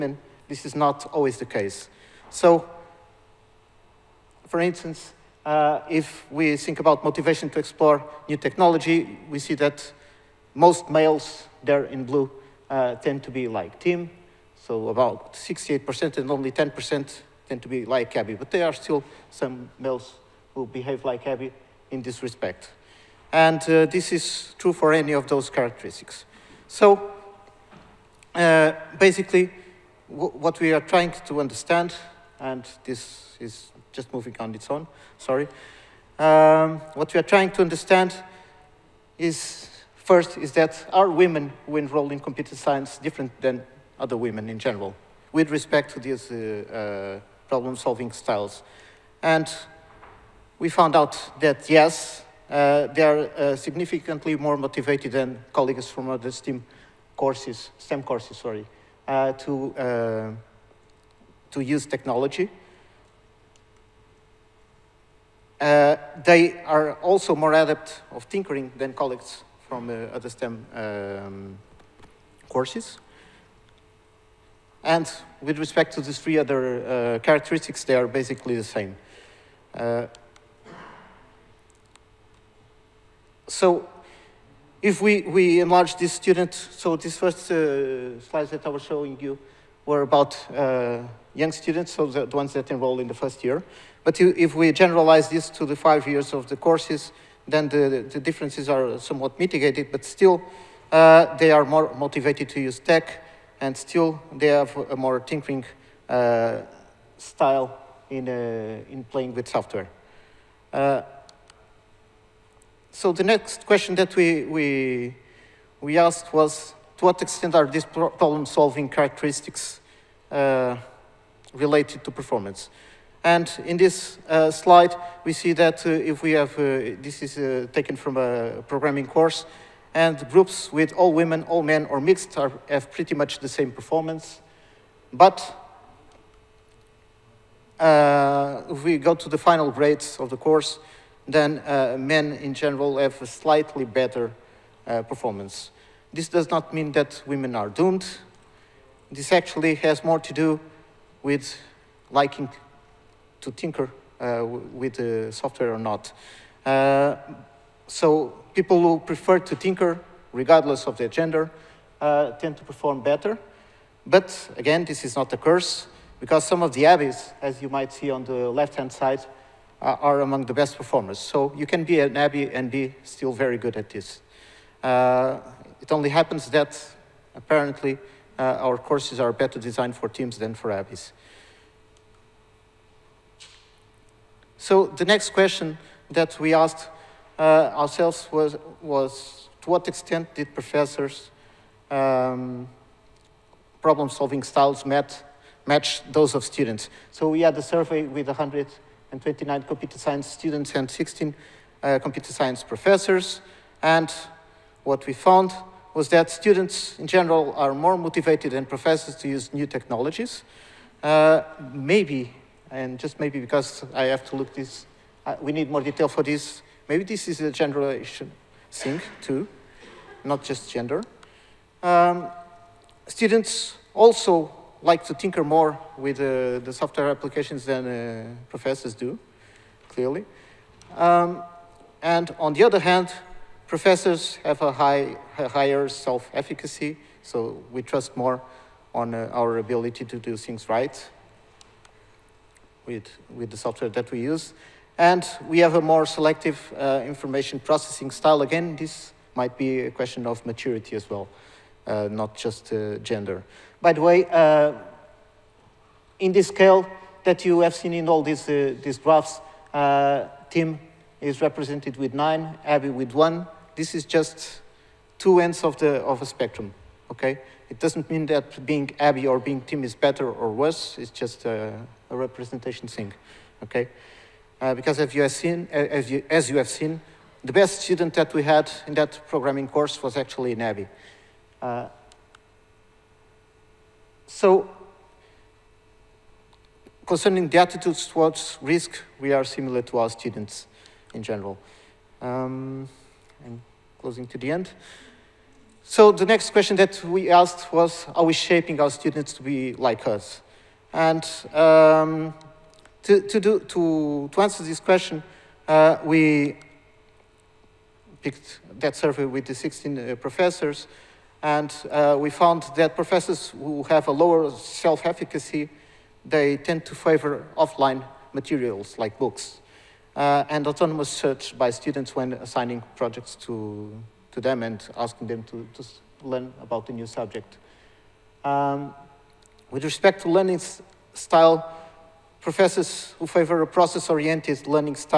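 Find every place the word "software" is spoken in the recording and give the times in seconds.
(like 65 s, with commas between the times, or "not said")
109 s, 155 s, 226 s, 243 s.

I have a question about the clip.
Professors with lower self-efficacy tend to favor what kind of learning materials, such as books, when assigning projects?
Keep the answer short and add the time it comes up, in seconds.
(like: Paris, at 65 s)
Offline materials, at 317 s.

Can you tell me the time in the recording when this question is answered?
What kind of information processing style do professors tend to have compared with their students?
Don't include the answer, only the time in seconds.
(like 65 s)
245 s.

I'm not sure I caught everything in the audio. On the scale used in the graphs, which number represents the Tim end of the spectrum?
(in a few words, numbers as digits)
9.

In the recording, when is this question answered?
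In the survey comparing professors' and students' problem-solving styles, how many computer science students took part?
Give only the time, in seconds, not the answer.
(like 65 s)
198 s.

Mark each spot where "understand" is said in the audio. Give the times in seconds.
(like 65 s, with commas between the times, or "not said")
31 s, 37 s.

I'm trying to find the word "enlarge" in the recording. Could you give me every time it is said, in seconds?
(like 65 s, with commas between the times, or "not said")
85 s.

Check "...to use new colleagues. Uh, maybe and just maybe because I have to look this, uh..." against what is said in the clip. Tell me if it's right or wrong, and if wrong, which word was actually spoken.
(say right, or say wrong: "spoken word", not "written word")
wrong: "technologies", not "colleagues".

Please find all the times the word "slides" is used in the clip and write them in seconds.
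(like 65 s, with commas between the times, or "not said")
88 s, 124 s.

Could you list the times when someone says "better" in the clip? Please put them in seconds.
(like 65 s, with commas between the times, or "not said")
143 s, 163 s, 179 s, 269 s.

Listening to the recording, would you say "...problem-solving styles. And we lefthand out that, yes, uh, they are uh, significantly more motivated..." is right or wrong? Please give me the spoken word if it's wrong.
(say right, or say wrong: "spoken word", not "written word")
wrong: "found", not "lefthand".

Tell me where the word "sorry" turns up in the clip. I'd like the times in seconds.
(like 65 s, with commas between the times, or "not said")
35 s, 58 s.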